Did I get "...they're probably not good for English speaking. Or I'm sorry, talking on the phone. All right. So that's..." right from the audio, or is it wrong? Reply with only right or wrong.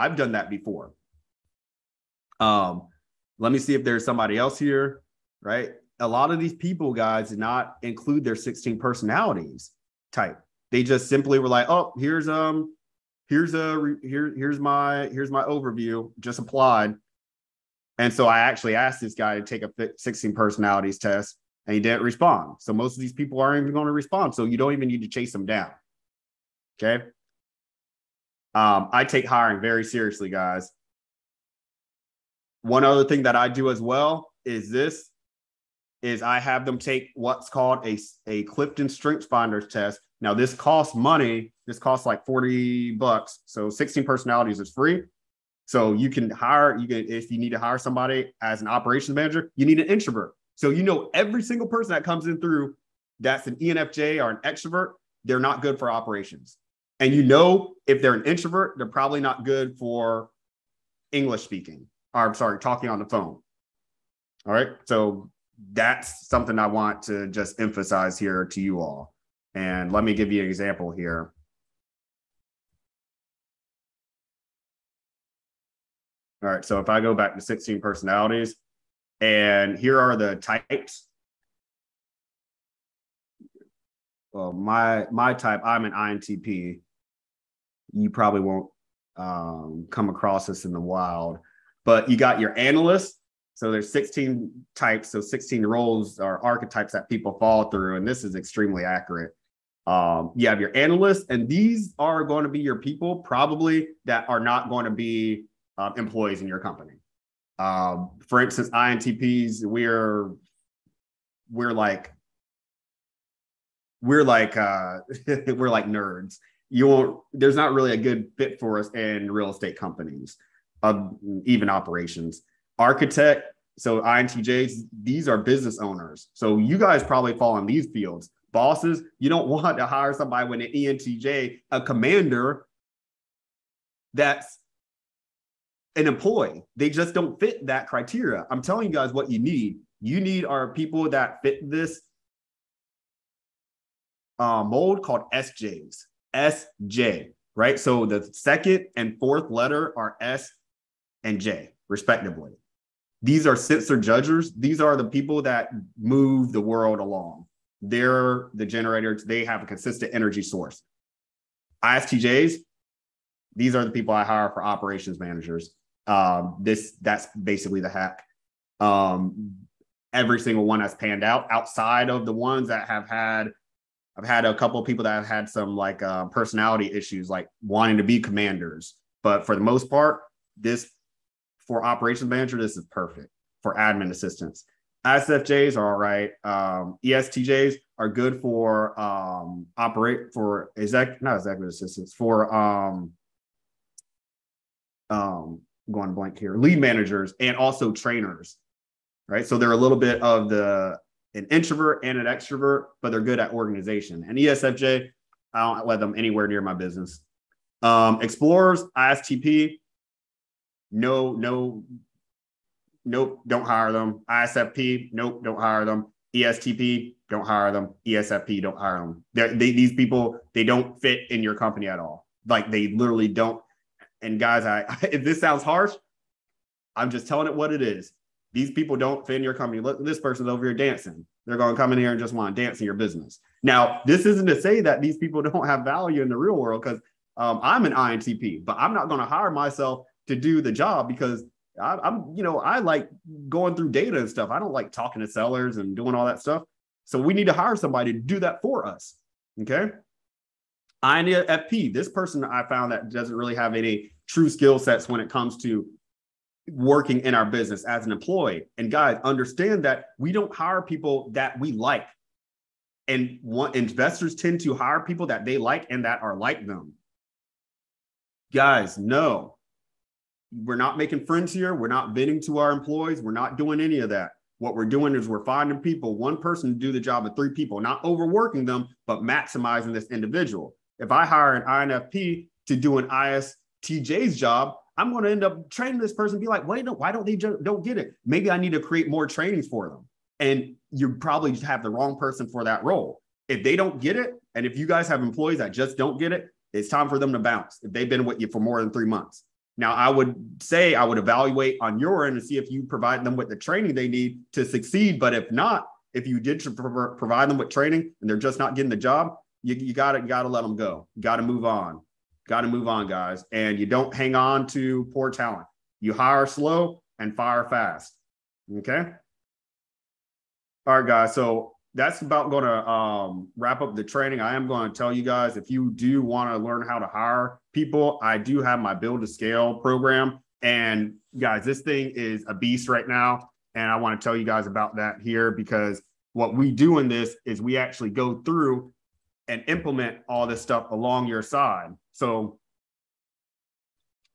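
right.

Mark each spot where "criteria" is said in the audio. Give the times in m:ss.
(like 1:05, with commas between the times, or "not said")
2:17.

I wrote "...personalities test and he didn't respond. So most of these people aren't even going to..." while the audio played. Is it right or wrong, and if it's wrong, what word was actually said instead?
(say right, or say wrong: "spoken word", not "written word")
right.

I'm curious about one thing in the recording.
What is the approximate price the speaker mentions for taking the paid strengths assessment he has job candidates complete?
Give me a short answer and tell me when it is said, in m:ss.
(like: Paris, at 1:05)
$40, at 0:42.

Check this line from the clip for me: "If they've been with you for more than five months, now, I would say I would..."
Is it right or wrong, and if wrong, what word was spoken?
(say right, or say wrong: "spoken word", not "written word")
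wrong: "three", not "five".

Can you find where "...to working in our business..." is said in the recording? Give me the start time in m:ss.
4:15.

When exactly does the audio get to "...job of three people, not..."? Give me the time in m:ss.
4:36.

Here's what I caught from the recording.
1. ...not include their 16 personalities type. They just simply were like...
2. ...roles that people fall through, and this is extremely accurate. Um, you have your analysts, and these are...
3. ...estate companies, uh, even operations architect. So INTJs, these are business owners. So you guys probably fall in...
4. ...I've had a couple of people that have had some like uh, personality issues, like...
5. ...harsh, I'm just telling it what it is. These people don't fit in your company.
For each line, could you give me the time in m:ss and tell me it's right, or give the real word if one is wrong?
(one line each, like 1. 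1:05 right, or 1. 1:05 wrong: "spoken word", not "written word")
1. 0:07 right
2. 1:36 wrong: "archetypes", not "roles"
3. 1:59 right
4. 2:54 right
5. 3:45 right.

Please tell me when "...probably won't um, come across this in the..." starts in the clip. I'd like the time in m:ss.
1:28.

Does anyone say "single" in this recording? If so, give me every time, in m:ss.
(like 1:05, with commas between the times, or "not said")
0:51, 2:50.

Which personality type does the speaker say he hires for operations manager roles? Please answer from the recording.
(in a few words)
ISTJ.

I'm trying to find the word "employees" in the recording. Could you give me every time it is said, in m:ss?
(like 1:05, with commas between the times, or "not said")
1:45, 2:16, 4:18, 4:32, 4:55.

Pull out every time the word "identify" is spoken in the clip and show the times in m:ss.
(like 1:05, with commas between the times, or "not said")
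not said.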